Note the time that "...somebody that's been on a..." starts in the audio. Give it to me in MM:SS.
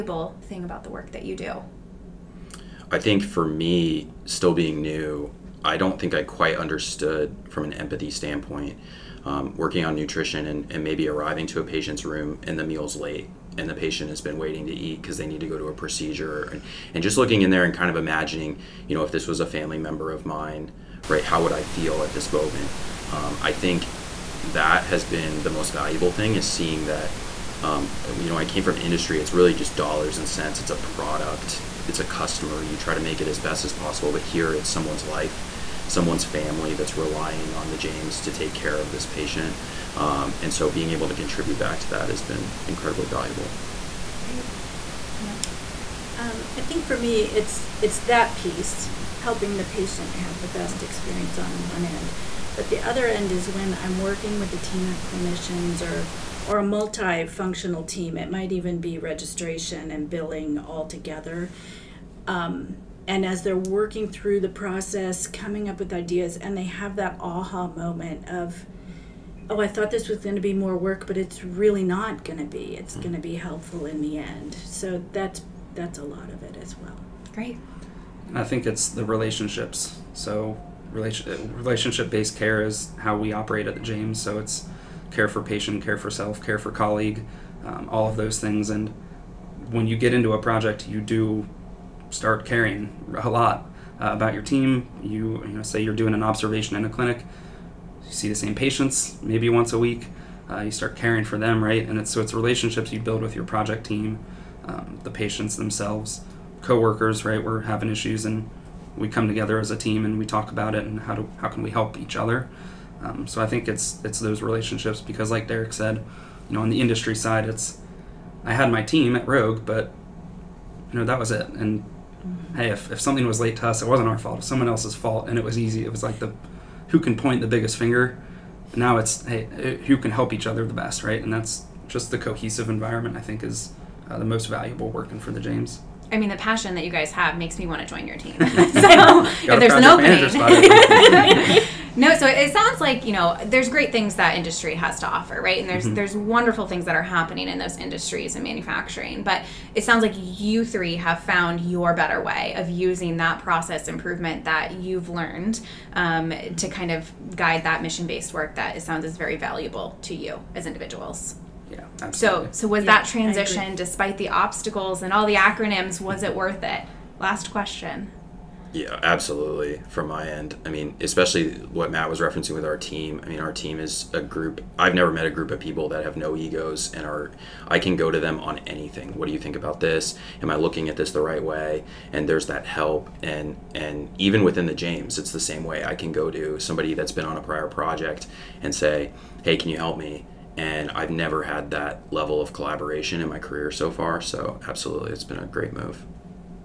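03:06.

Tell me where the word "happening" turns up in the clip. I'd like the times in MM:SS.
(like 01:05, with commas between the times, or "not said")
02:27.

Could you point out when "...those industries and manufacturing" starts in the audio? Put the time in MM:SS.
02:27.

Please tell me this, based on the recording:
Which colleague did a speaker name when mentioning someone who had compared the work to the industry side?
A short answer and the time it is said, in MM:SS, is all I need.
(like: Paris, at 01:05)
Derek, at 01:55.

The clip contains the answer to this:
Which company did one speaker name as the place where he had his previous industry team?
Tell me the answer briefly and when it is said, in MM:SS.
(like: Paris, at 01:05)
Rogue, at 01:59.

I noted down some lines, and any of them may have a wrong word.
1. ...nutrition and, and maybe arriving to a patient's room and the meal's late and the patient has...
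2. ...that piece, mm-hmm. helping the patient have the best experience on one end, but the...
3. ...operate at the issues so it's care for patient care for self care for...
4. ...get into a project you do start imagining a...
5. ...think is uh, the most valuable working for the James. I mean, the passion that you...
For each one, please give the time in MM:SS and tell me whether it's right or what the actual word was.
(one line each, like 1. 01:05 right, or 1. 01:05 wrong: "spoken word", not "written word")
1. 00:09 right
2. 00:47 right
3. 01:23 wrong: "james", not "issues"
4. 01:29 wrong: "caring", not "imagining"
5. 02:13 right.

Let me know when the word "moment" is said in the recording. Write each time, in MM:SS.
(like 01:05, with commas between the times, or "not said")
00:22, 01:07.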